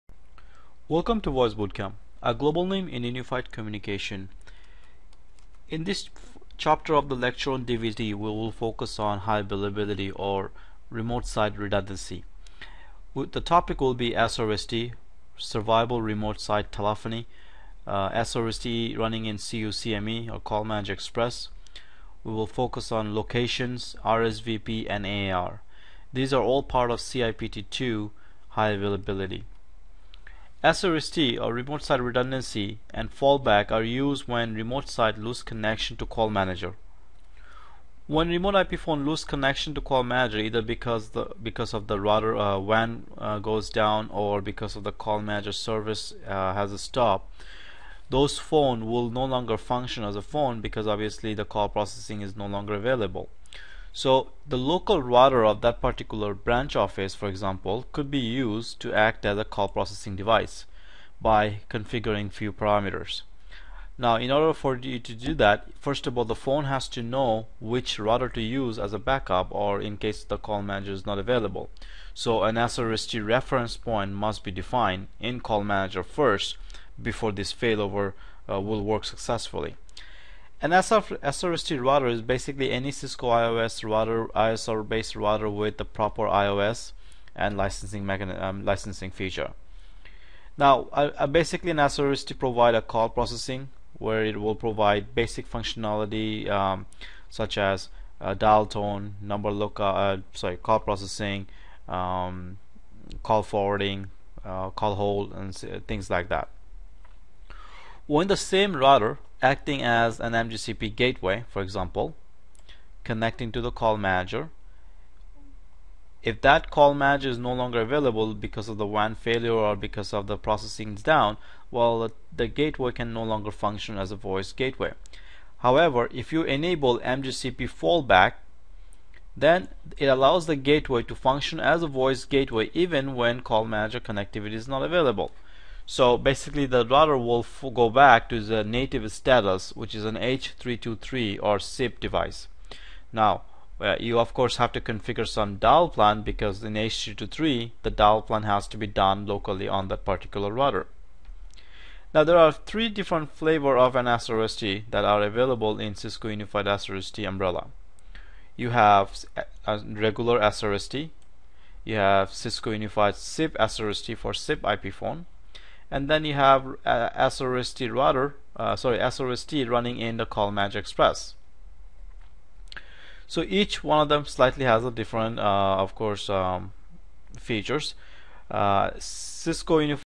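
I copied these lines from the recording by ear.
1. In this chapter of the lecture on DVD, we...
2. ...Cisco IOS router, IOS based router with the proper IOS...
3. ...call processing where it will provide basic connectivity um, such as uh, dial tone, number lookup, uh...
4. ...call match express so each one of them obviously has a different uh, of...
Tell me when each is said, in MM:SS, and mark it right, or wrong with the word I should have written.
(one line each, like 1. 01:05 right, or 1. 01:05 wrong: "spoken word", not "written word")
1. 00:05 right
2. 01:22 wrong: "ISR", not "IOS"
3. 01:32 wrong: "functionality", not "connectivity"
4. 02:50 wrong: "slightly", not "obviously".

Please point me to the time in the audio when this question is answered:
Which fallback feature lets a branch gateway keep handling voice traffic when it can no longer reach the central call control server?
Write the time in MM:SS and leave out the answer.
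02:06.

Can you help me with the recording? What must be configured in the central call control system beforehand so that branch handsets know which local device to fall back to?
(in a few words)
SRST reference point.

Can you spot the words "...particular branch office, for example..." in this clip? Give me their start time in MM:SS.
00:55.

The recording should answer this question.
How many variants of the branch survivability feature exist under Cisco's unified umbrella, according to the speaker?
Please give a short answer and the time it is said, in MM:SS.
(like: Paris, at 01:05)
3, at 02:32.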